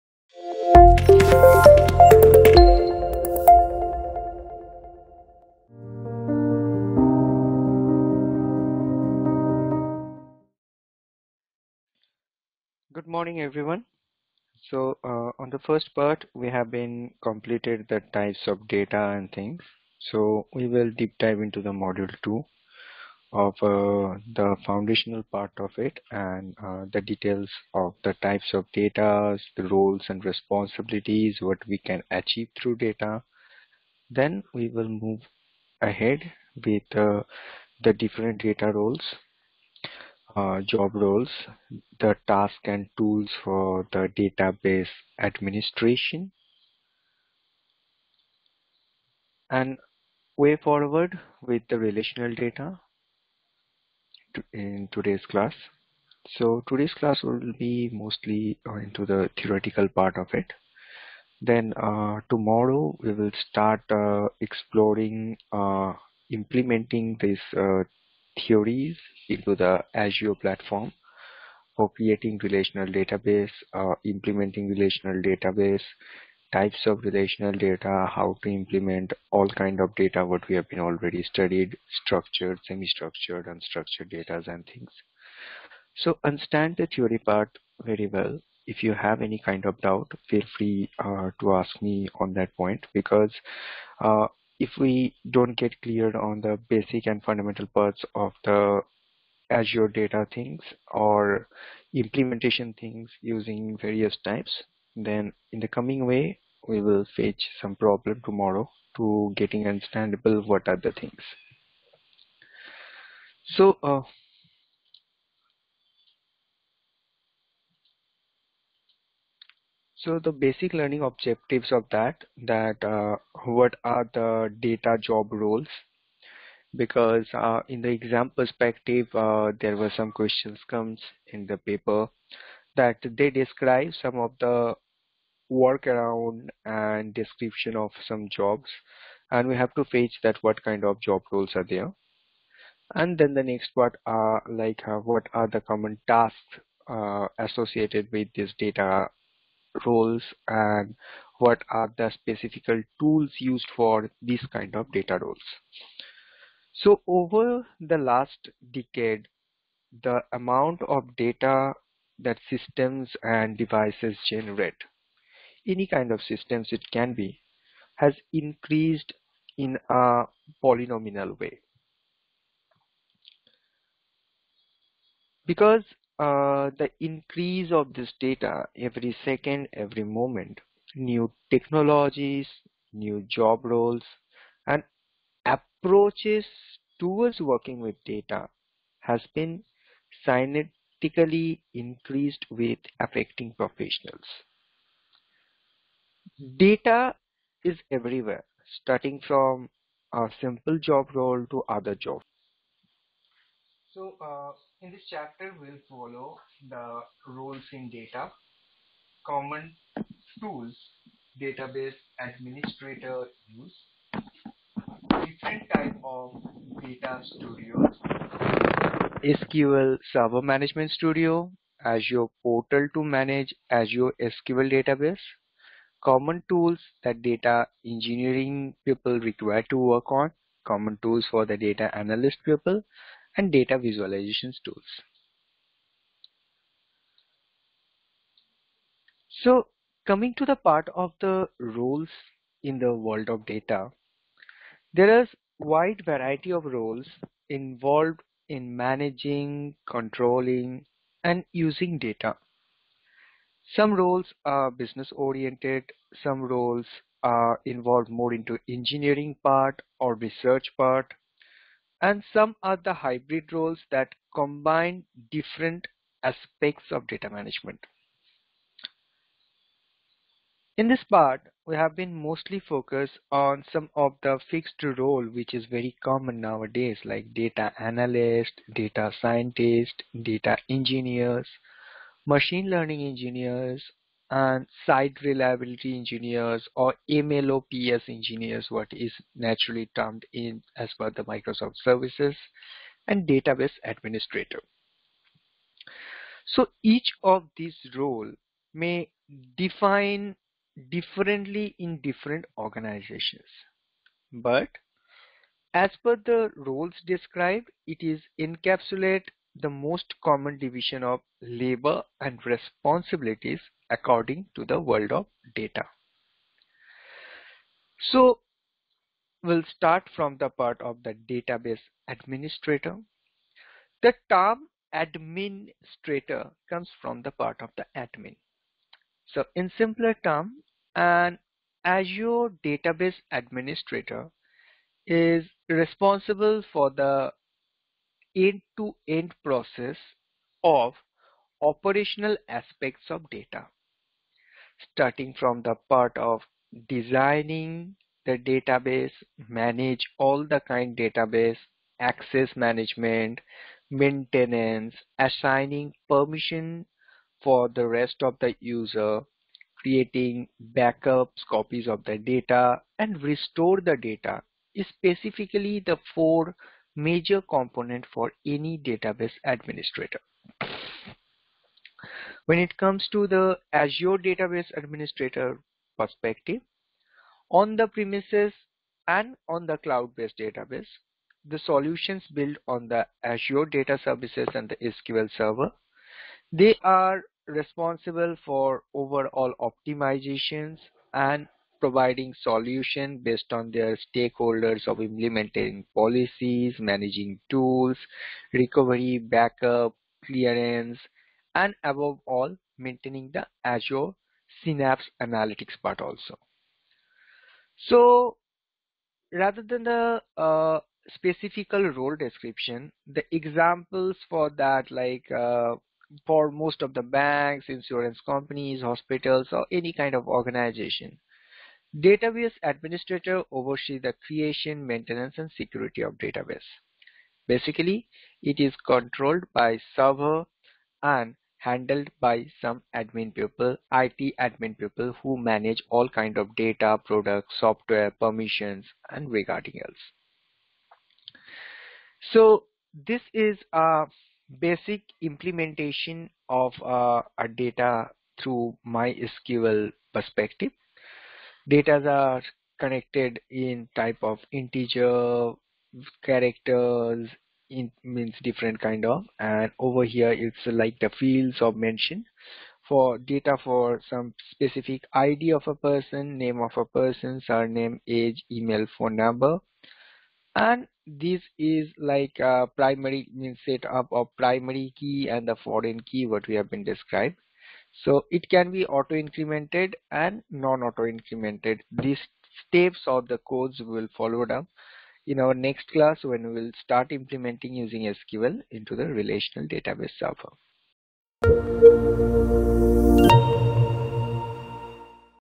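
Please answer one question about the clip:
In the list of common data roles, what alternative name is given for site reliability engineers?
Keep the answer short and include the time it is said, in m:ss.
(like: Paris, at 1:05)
MLOps engineers, at 4:47.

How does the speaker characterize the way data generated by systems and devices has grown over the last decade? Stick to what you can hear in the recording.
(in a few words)
in a polynomial way.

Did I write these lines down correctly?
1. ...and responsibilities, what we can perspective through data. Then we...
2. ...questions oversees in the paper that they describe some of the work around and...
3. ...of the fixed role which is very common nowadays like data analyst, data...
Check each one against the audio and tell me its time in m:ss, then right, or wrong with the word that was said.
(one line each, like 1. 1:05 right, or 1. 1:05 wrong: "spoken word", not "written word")
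1. 0:30 wrong: "achieve", not "perspective"
2. 2:10 wrong: "comes", not "oversees"
3. 4:33 right.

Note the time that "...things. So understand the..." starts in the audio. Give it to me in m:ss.
1:24.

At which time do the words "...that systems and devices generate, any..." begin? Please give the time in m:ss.
2:42.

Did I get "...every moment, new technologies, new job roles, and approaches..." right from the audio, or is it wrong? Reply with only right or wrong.
right.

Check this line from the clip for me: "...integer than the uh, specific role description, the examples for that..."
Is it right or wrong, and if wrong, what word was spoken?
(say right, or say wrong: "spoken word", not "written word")
wrong: "rather", not "integer".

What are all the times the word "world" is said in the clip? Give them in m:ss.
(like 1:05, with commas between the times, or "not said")
4:02, 5:14.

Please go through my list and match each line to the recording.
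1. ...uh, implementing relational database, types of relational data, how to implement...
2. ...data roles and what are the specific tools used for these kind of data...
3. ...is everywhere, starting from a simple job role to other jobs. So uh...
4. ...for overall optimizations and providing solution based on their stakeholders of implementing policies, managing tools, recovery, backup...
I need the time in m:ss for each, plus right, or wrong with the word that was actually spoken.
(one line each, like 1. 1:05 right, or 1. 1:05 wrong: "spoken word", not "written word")
1. 1:13 right
2. 2:28 right
3. 3:17 right
4. 6:28 right.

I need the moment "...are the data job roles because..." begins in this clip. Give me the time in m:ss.
2:03.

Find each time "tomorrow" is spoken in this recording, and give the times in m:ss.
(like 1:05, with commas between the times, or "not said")
1:02, 1:48.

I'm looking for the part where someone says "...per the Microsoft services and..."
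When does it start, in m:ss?
4:50.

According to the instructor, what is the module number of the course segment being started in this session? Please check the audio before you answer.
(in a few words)
2.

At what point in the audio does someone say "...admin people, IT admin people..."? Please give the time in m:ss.
7:12.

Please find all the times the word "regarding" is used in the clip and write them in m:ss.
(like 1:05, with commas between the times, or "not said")
7:19.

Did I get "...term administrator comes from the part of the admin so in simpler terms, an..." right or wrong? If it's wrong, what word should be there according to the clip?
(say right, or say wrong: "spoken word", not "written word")
right.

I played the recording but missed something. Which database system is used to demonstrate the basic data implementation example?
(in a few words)
MySQL.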